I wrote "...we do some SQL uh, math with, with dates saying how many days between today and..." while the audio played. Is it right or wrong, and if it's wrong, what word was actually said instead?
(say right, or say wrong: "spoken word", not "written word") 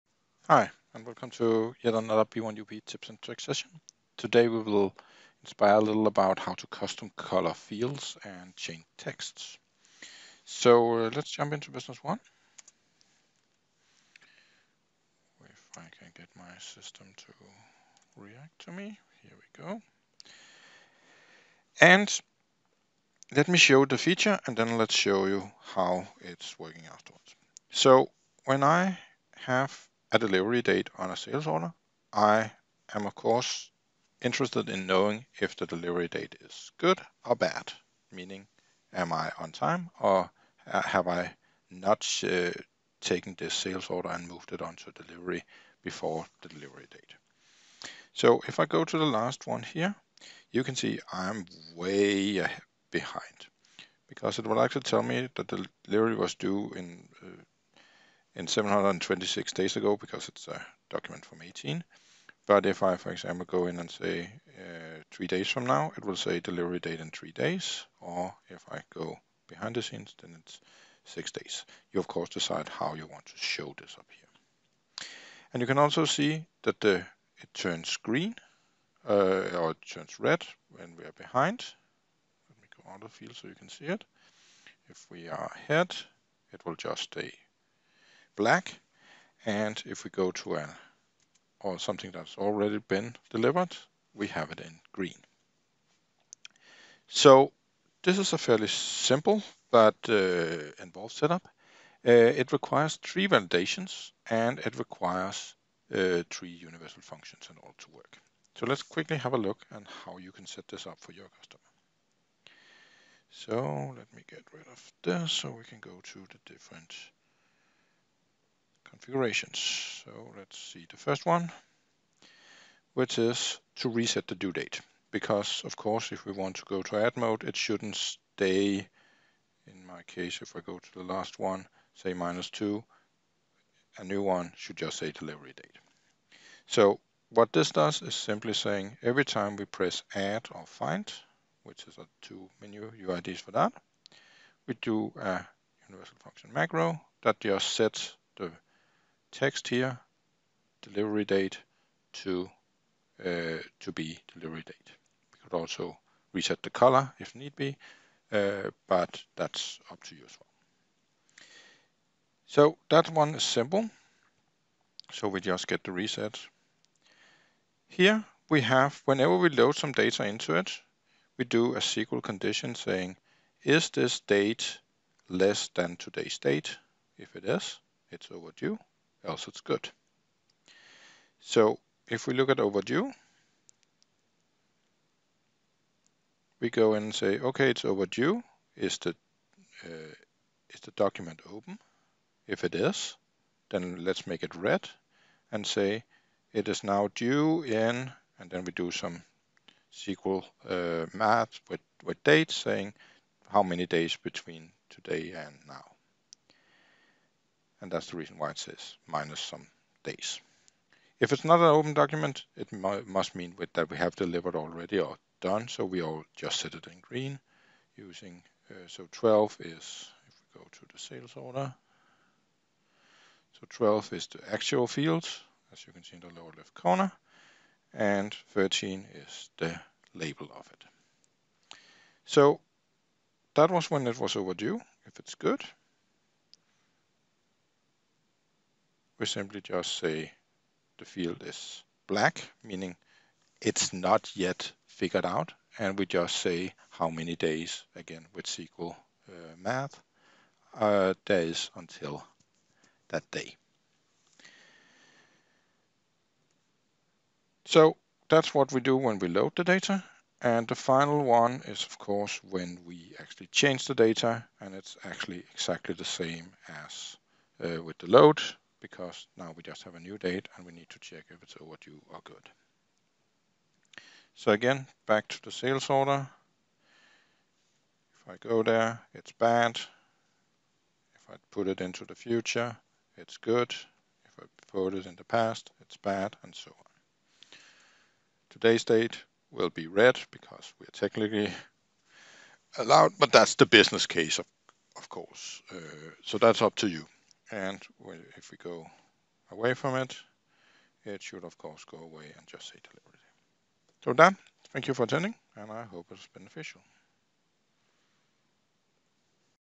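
right.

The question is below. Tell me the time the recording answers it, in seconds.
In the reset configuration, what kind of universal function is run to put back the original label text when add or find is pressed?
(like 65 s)
145 s.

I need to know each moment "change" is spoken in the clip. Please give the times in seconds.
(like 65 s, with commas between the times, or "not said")
8 s, 263 s.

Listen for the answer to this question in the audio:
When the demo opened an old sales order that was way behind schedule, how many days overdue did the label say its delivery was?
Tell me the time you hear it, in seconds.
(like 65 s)
58 s.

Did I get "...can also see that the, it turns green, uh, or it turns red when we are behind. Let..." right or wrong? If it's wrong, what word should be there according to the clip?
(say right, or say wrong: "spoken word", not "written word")
right.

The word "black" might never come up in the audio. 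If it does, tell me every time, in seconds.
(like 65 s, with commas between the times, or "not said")
88 s, 242 s.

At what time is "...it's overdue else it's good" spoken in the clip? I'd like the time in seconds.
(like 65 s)
178 s.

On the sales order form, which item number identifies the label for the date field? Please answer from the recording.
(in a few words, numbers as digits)
13.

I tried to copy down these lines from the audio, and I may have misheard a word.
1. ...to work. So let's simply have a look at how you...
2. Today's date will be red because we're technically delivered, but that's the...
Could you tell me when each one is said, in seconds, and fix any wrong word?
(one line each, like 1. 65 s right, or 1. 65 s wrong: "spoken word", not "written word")
1. 107 s wrong: "quickly", not "simply"
2. 288 s wrong: "allowed", not "delivered".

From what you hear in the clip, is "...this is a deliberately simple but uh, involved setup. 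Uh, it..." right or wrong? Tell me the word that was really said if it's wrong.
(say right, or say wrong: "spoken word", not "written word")
wrong: "fairly", not "deliberately".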